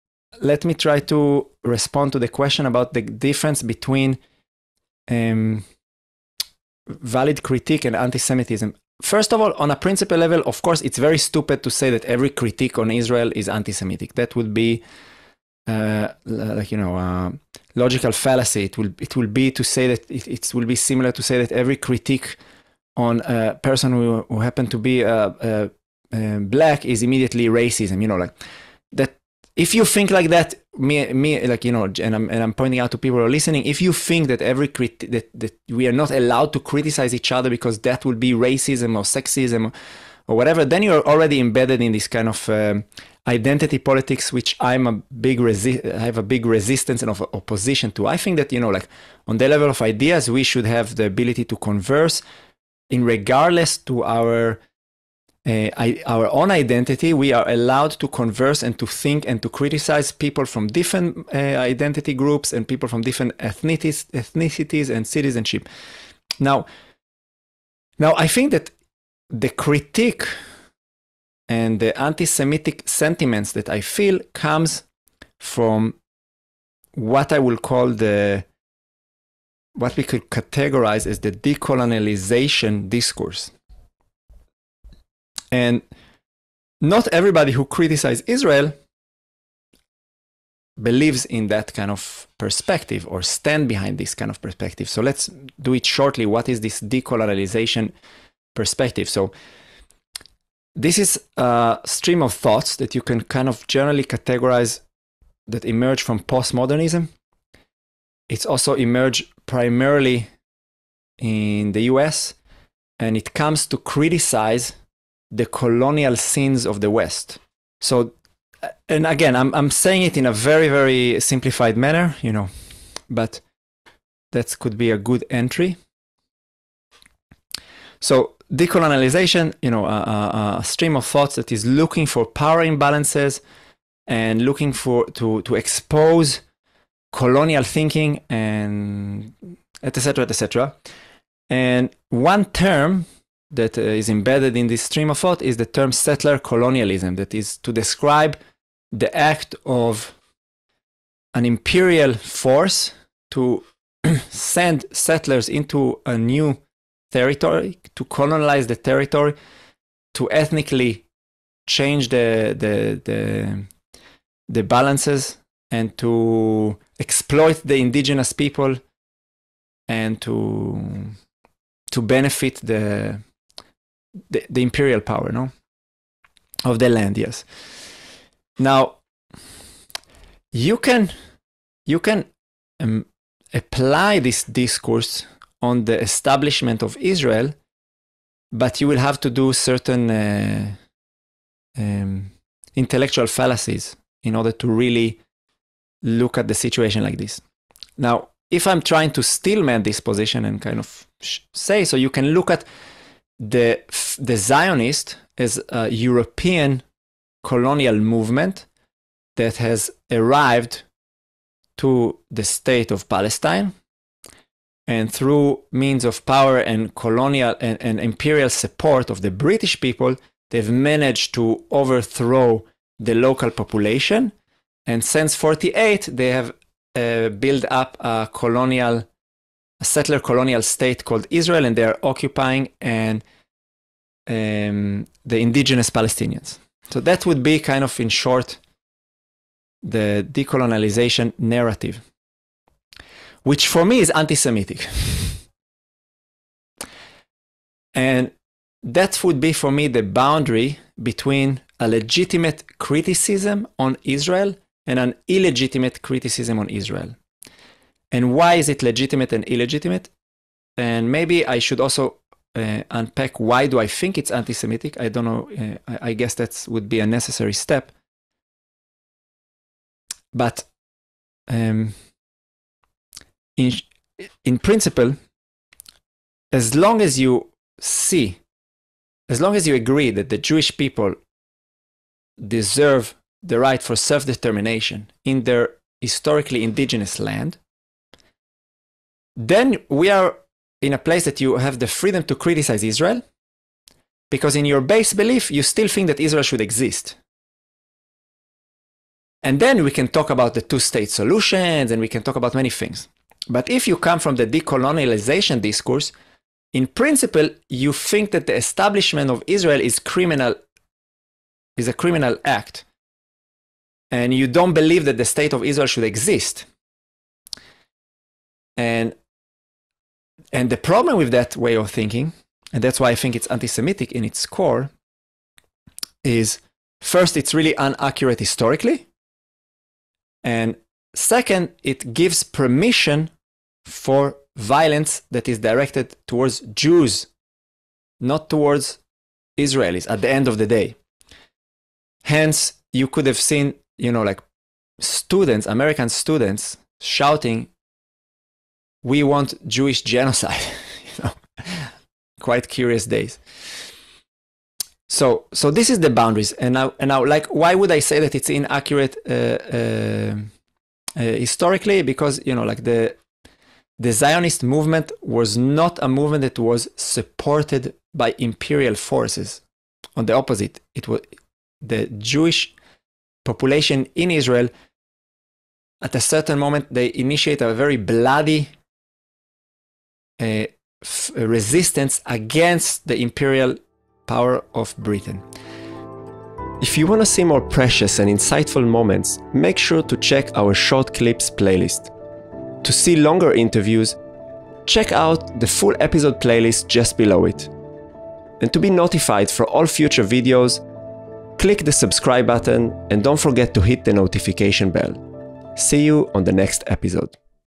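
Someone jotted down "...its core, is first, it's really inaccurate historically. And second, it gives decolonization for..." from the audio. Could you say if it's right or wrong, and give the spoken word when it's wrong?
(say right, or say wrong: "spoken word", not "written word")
wrong: "permission", not "decolonization".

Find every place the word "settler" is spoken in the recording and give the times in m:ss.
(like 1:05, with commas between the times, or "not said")
2:25, 2:34, 3:49.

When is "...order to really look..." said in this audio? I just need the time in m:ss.
3:14.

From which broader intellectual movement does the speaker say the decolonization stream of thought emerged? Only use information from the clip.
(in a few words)
postmodernism.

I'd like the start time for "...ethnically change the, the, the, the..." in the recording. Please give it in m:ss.
2:40.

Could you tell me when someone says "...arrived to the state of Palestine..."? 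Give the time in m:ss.
3:30.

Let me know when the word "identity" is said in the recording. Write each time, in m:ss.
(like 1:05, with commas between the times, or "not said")
0:43, 0:56, 1:01.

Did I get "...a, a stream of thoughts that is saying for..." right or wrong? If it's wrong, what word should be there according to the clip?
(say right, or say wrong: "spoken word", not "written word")
wrong: "looking", not "saying".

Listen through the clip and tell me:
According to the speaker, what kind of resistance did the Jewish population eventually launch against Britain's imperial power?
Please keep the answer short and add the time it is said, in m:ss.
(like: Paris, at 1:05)
bloody resistance, at 6:17.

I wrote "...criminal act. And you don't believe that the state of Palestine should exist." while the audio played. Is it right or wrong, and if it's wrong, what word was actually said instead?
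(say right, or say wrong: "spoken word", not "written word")
wrong: "Israel", not "Palestine".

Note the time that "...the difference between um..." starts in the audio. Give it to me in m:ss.
0:02.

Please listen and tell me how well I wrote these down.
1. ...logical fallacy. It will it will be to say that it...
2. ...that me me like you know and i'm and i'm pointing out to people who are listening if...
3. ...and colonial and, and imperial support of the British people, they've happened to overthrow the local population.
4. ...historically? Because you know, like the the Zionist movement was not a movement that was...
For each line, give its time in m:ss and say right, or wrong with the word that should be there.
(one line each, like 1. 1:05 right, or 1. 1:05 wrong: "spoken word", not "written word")
1. 0:17 right
2. 0:30 right
3. 3:36 wrong: "managed", not "happened"
4. 6:01 right.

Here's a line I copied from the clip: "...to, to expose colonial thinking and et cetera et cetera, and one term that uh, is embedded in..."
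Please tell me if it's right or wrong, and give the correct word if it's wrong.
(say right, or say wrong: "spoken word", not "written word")
right.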